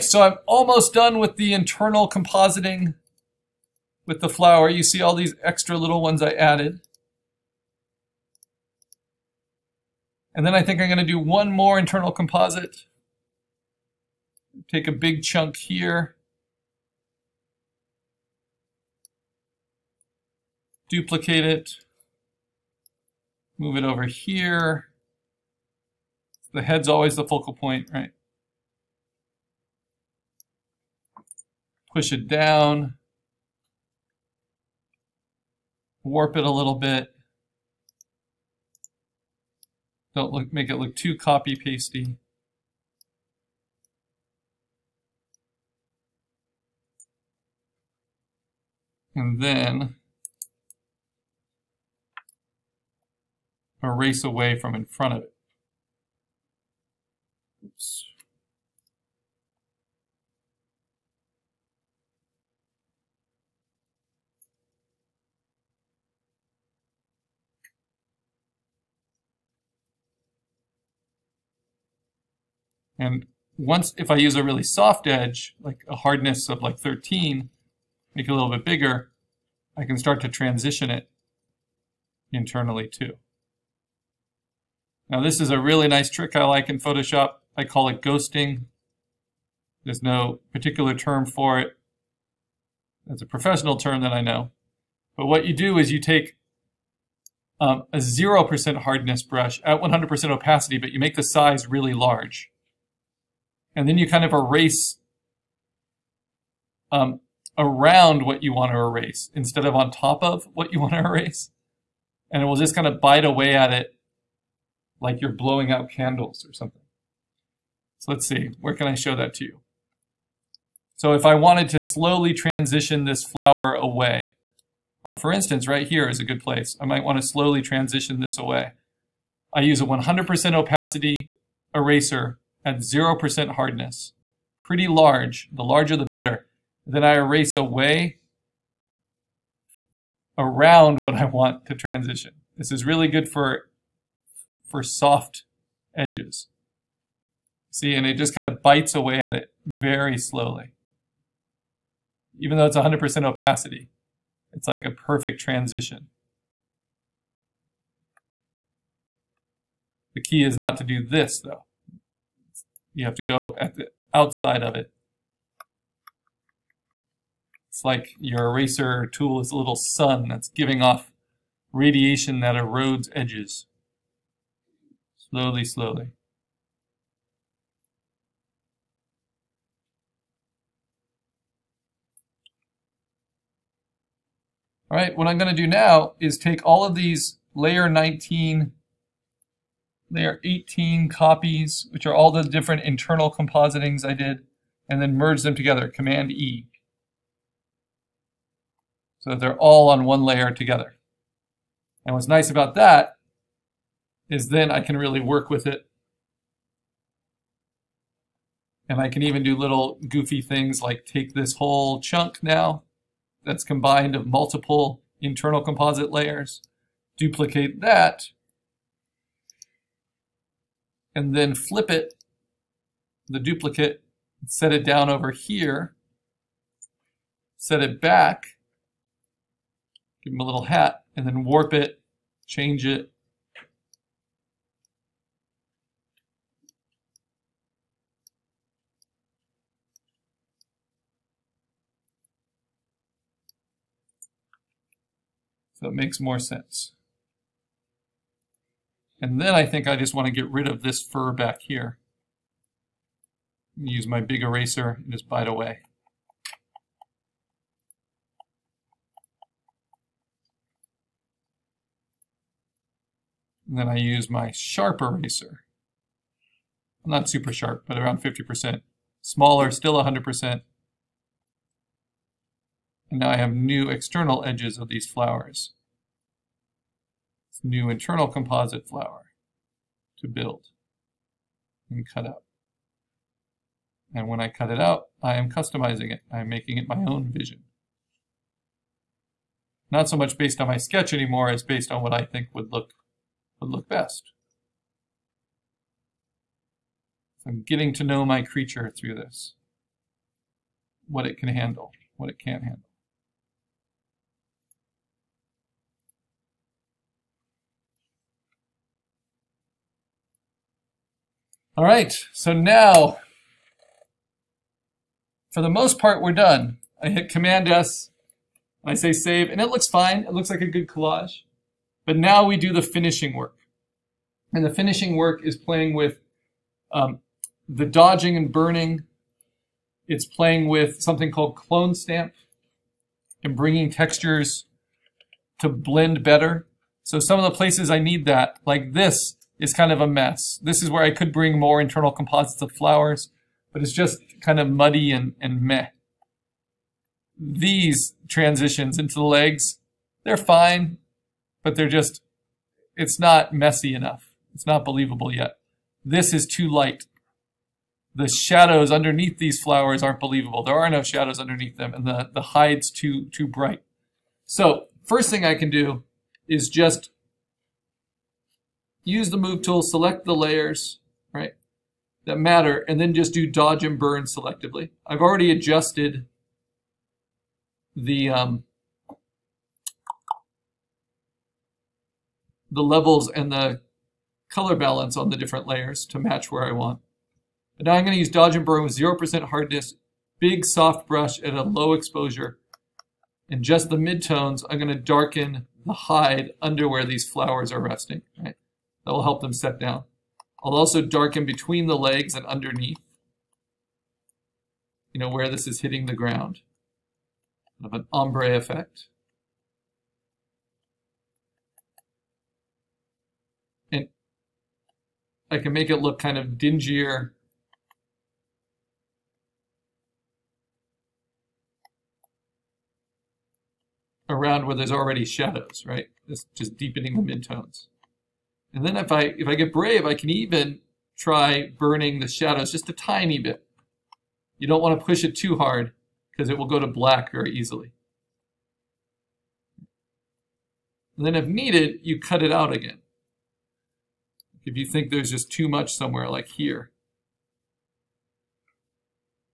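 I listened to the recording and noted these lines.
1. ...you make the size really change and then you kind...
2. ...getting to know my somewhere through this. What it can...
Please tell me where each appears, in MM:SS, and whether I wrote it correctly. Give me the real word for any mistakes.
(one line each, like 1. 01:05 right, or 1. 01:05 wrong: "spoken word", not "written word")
1. 01:40 wrong: "large", not "change"
2. 04:57 wrong: "creature", not "somewhere".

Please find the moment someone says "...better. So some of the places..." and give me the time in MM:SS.
05:36.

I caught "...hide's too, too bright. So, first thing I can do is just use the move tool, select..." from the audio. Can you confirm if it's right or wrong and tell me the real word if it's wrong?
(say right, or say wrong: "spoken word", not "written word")
right.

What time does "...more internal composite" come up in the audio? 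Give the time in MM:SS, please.
00:11.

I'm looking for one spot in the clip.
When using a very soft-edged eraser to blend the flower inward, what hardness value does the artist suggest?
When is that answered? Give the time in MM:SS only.
01:16.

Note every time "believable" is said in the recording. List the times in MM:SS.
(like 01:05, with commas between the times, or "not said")
05:54, 06:00.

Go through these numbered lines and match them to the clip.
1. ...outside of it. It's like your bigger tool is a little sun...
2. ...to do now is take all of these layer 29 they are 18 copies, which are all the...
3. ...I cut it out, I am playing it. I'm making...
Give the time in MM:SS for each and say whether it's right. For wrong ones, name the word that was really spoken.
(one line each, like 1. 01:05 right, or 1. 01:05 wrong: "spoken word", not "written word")
1. 02:44 wrong: "eraser", not "bigger"
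2. 03:05 wrong: "19", not "29"
3. 04:44 wrong: "customizing", not "playing".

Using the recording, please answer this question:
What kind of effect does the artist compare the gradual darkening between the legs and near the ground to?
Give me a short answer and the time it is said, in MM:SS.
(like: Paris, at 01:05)
ombre effect, at 06:48.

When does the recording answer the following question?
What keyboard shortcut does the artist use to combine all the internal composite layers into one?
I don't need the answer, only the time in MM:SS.
03:15.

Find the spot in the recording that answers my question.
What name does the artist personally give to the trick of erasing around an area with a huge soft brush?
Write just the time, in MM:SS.
01:28.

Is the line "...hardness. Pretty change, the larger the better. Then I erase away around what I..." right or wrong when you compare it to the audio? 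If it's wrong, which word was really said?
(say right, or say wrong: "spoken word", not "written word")
wrong: "large", not "change".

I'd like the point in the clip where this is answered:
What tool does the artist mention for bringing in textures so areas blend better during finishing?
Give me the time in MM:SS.
05:31.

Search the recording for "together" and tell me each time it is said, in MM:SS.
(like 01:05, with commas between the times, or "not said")
03:15, 03:20.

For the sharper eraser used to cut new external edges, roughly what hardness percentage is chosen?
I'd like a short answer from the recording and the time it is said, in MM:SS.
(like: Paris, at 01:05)
50%, at 04:28.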